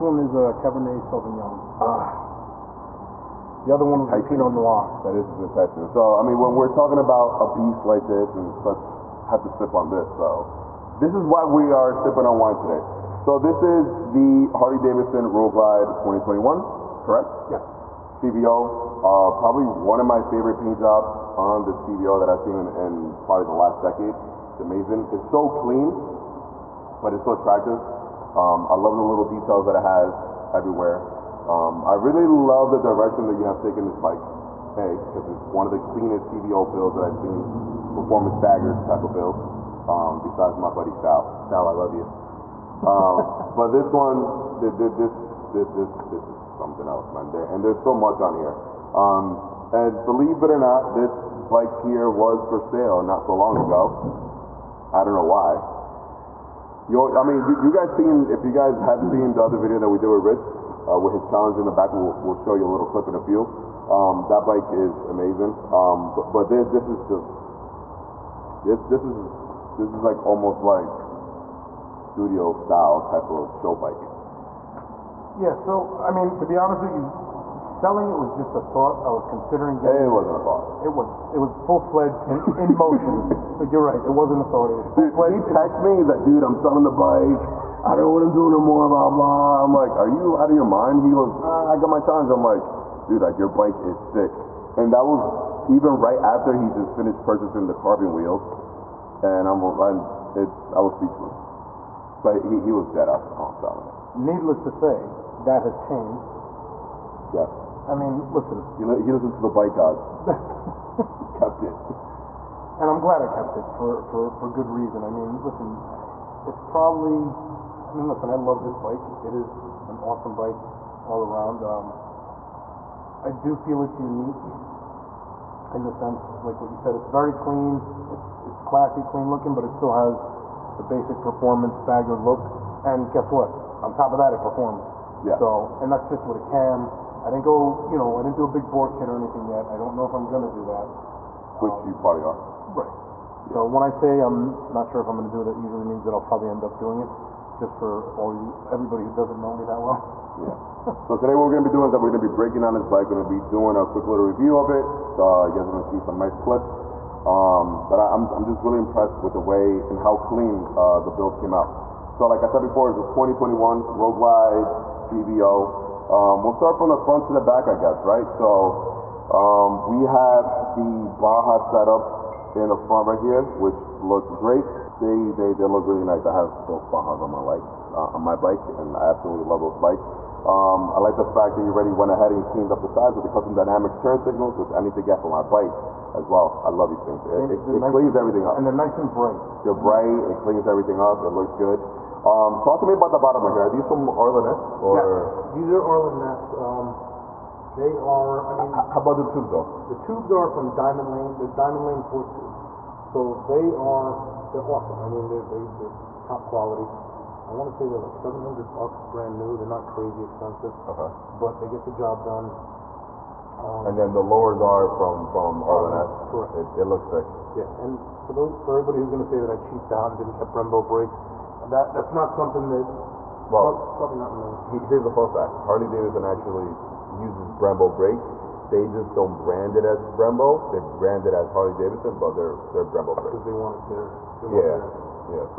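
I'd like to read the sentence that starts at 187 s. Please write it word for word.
It, it, it nice cleans everything up.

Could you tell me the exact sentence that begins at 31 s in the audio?
Um, I really love the direction that you have taken this bike.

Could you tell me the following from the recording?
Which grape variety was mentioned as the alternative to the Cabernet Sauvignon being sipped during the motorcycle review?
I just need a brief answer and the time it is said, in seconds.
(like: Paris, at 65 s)
Pinot Noir, at 4 s.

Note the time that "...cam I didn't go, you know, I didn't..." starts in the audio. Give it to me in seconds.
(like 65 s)
136 s.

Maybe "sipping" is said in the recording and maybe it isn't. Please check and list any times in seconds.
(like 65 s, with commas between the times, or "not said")
11 s.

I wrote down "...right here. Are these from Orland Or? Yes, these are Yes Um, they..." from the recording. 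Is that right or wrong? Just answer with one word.
wrong.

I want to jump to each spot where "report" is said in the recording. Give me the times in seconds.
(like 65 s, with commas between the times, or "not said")
not said.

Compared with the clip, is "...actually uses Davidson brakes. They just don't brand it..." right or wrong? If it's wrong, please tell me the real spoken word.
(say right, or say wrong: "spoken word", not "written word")
wrong: "Brembo", not "Davidson".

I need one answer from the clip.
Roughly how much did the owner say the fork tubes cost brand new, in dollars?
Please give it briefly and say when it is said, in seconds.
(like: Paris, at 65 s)
$700, at 208 s.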